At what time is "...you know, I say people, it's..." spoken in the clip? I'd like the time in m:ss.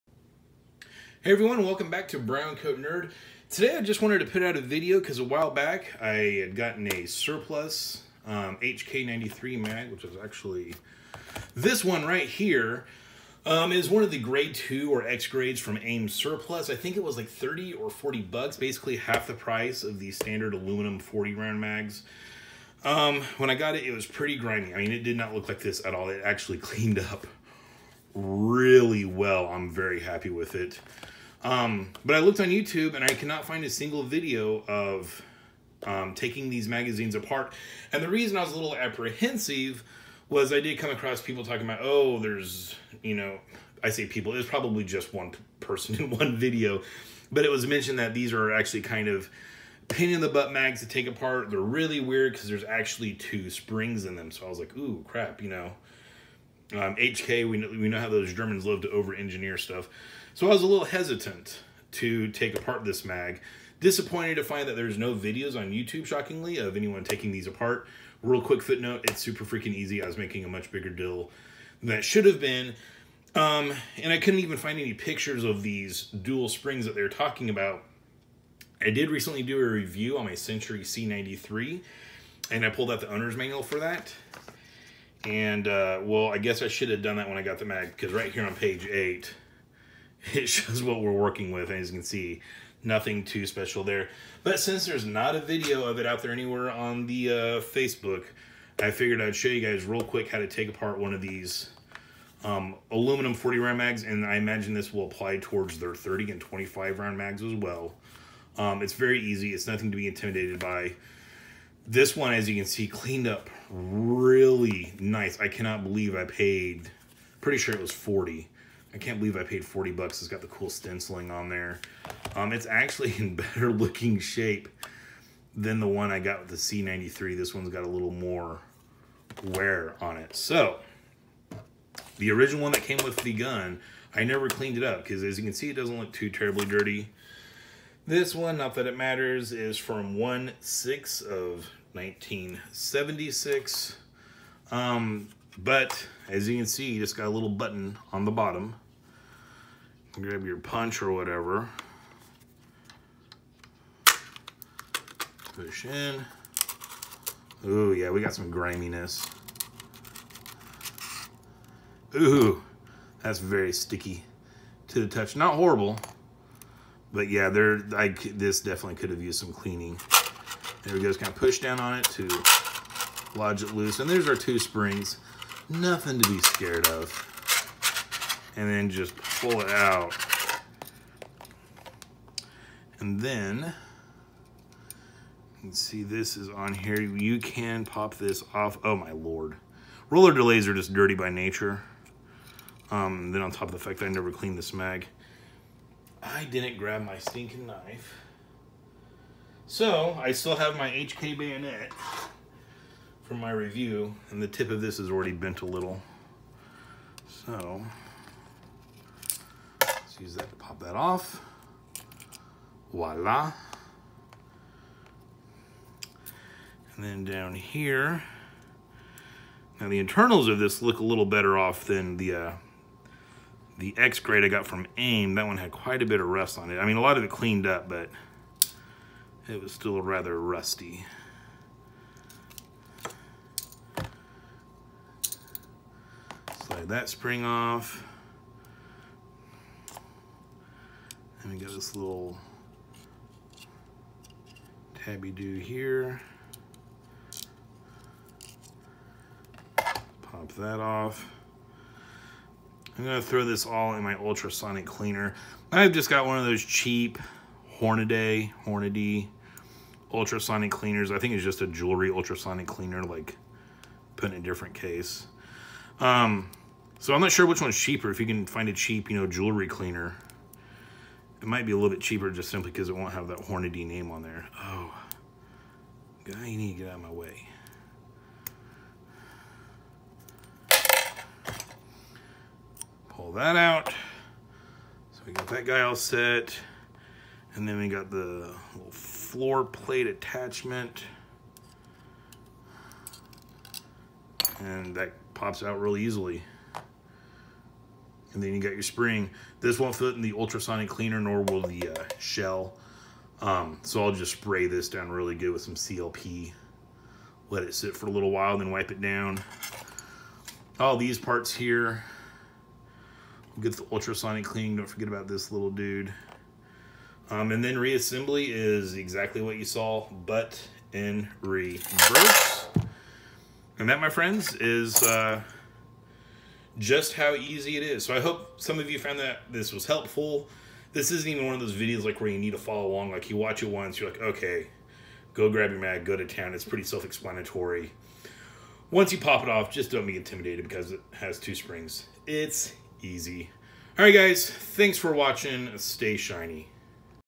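0:43.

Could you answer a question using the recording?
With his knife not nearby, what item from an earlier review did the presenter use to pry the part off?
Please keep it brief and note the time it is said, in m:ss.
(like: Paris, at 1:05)
HK bayonet, at 3:20.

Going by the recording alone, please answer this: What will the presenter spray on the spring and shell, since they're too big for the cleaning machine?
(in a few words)
CLP.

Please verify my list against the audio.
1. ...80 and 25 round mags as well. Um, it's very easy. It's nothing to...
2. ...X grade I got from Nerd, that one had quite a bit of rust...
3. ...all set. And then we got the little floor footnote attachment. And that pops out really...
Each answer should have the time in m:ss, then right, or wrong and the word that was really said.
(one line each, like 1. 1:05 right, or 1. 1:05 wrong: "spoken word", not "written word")
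1. 1:45 wrong: "30", not "80"
2. 3:43 wrong: "AIM", not "Nerd"
3. 4:45 wrong: "plate", not "footnote".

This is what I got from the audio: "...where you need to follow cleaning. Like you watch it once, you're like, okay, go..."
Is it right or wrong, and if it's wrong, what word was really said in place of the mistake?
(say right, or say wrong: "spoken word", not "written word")
wrong: "along", not "cleaning".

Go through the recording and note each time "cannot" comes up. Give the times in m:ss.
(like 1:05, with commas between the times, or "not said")
0:33, 1:55.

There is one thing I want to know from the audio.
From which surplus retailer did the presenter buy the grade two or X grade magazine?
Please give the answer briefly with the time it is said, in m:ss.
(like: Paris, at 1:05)
AIM surplus, at 0:15.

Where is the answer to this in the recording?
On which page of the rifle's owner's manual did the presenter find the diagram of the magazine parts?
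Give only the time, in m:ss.
1:28.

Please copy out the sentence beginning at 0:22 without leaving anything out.
Um, when I got it, it was pretty grimy.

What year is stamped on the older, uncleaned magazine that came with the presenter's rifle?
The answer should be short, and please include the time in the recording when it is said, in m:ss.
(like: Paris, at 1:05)
1976, at 2:21.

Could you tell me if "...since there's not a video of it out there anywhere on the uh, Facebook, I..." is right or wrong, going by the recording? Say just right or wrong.
right.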